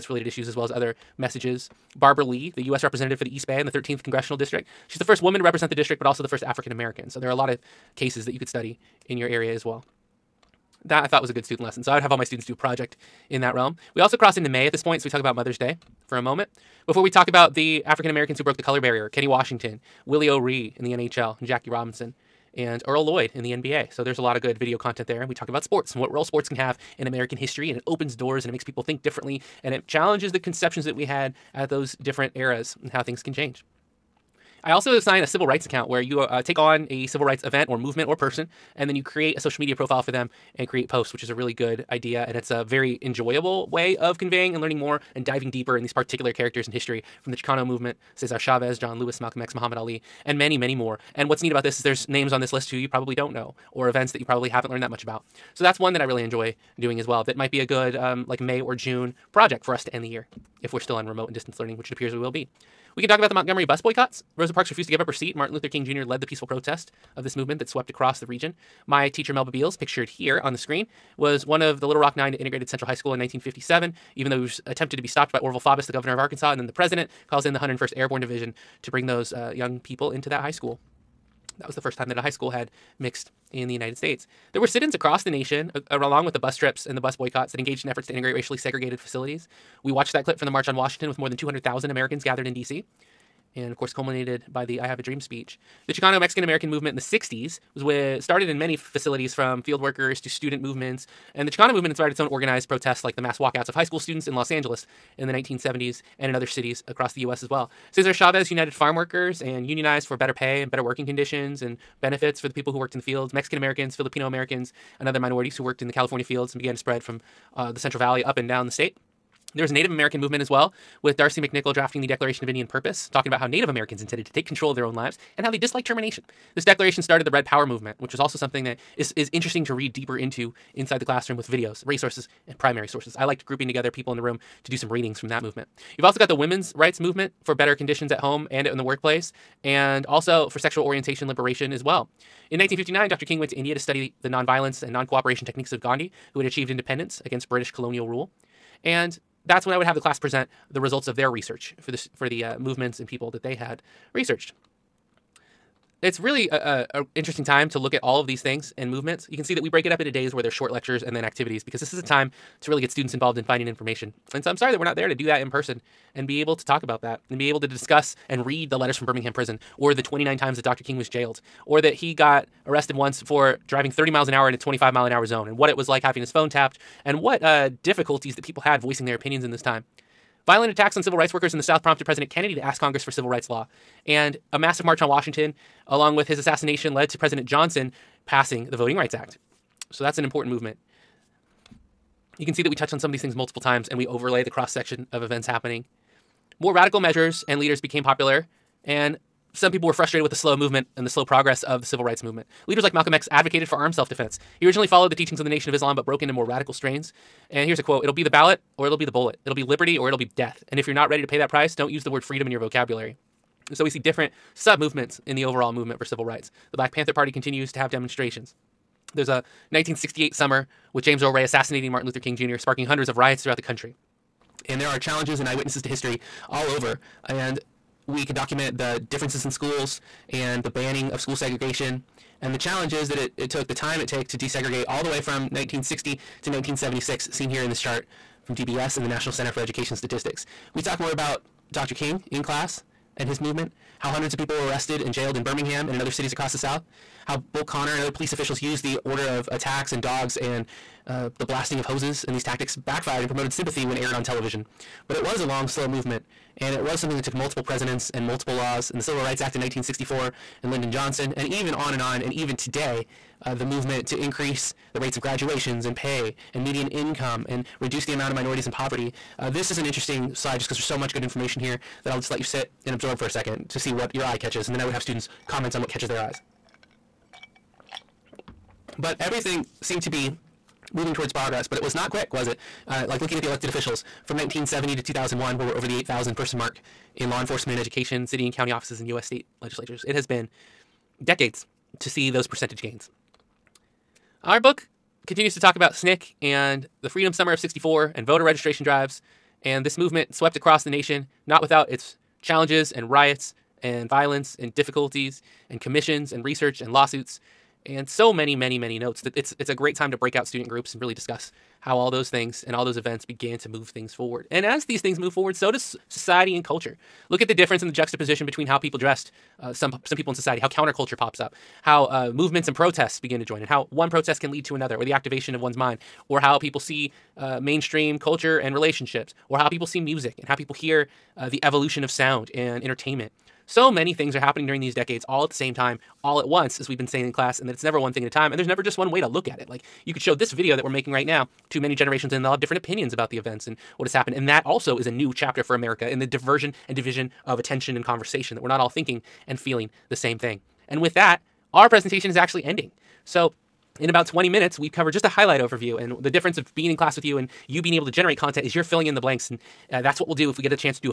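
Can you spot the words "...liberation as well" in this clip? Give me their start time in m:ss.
2:21.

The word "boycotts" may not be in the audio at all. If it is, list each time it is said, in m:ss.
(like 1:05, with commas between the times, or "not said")
1:03, 1:27.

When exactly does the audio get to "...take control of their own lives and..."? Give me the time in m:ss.
2:04.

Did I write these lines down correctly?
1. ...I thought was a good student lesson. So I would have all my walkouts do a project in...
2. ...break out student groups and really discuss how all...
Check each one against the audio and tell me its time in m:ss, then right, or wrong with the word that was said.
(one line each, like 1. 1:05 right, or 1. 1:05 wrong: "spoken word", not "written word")
1. 0:11 wrong: "students", not "walkouts"
2. 5:10 right.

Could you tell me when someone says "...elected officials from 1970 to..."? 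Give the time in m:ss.
4:43.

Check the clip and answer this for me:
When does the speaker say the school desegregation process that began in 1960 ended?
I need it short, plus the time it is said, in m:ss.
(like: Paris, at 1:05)
1976, at 3:56.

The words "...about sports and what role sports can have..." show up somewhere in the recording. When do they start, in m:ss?
0:25.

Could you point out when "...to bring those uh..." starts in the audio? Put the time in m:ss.
1:18.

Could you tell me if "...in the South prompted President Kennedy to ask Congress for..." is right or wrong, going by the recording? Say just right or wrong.
right.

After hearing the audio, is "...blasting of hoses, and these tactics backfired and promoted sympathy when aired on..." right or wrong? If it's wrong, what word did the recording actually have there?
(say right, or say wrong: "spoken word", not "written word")
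right.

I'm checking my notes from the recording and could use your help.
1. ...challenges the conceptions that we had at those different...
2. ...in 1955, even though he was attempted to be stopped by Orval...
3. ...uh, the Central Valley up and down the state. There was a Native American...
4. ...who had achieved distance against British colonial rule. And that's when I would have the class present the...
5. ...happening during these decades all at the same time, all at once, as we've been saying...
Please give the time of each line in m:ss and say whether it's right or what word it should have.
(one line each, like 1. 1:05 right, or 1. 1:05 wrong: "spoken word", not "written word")
1. 0:29 right
2. 1:13 wrong: "1957", not "1955"
3. 1:57 right
4. 2:26 wrong: "independence", not "distance"
5. 5:34 right.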